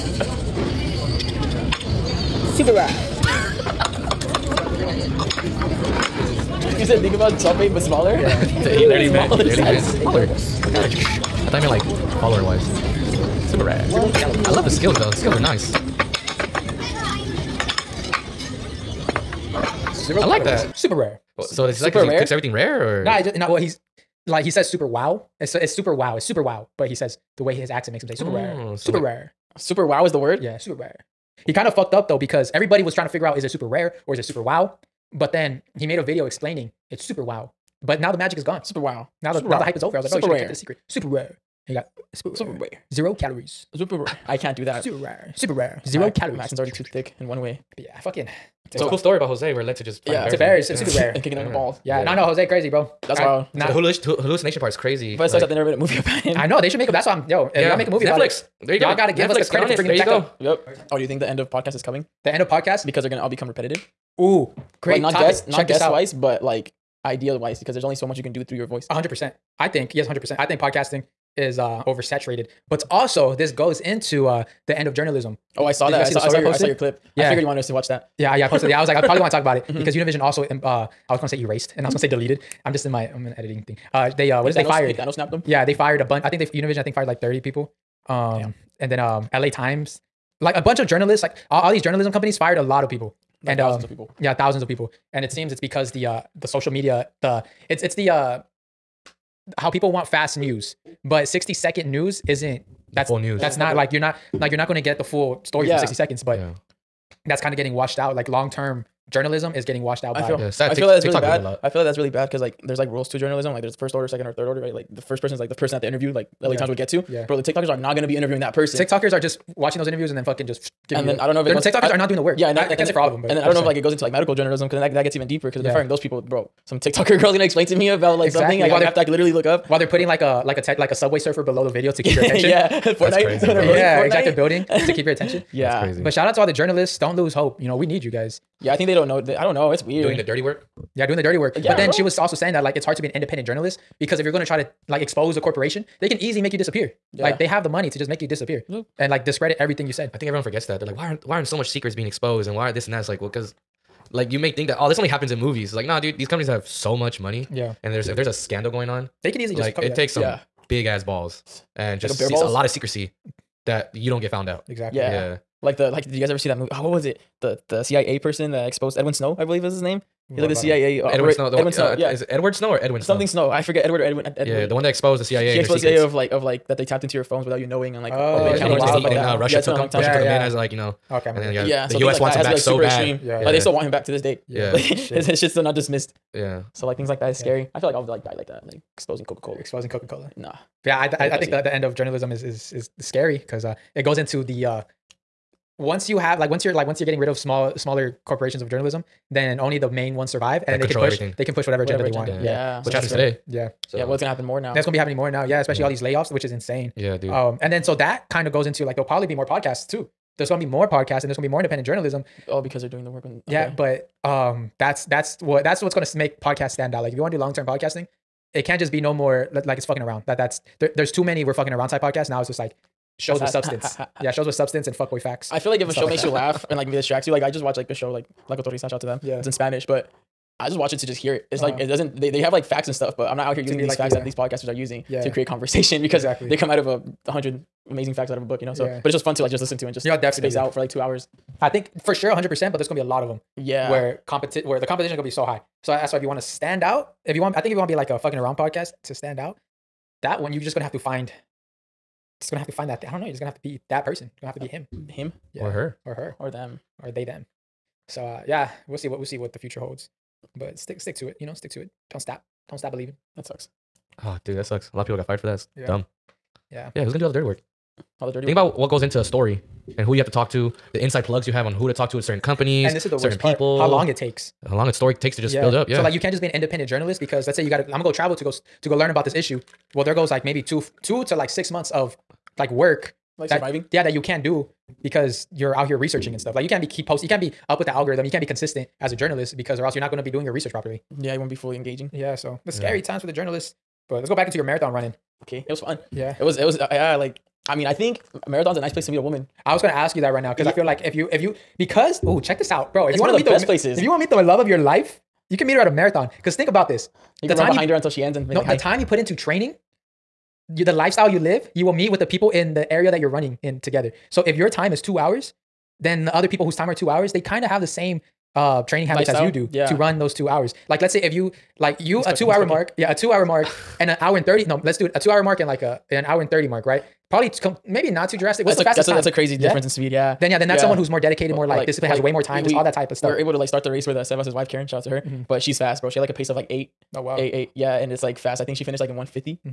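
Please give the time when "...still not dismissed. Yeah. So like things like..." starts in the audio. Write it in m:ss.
3:05.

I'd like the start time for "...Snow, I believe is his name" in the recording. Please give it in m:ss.
2:49.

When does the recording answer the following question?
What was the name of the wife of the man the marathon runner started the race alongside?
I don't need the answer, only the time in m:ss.
5:34.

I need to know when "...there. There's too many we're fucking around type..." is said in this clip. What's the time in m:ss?
3:40.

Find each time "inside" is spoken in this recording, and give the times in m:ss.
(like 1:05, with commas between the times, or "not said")
4:31.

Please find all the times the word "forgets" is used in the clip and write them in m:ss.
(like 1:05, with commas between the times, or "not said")
2:30, 2:53.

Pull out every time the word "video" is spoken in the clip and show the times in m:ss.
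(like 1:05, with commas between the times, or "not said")
0:36, 2:11.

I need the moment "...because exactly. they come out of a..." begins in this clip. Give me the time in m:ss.
3:56.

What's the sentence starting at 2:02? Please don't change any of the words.
Yeah, and I, I, can't and say for all of them, but and then I don't know saying.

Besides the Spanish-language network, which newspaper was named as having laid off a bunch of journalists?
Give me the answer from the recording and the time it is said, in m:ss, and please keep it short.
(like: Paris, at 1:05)
LA Times, at 1:29.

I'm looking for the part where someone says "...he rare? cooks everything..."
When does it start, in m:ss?
0:22.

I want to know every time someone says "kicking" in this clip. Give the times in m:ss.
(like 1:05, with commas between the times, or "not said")
0:51.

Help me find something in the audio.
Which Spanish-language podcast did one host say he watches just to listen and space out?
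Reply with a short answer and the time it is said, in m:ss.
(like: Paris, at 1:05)
La Cotorrisa, at 3:48.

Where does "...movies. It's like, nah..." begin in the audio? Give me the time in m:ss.
2:35.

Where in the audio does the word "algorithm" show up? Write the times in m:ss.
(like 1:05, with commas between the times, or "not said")
4:47.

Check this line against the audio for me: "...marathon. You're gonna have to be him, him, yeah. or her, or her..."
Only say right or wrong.
wrong.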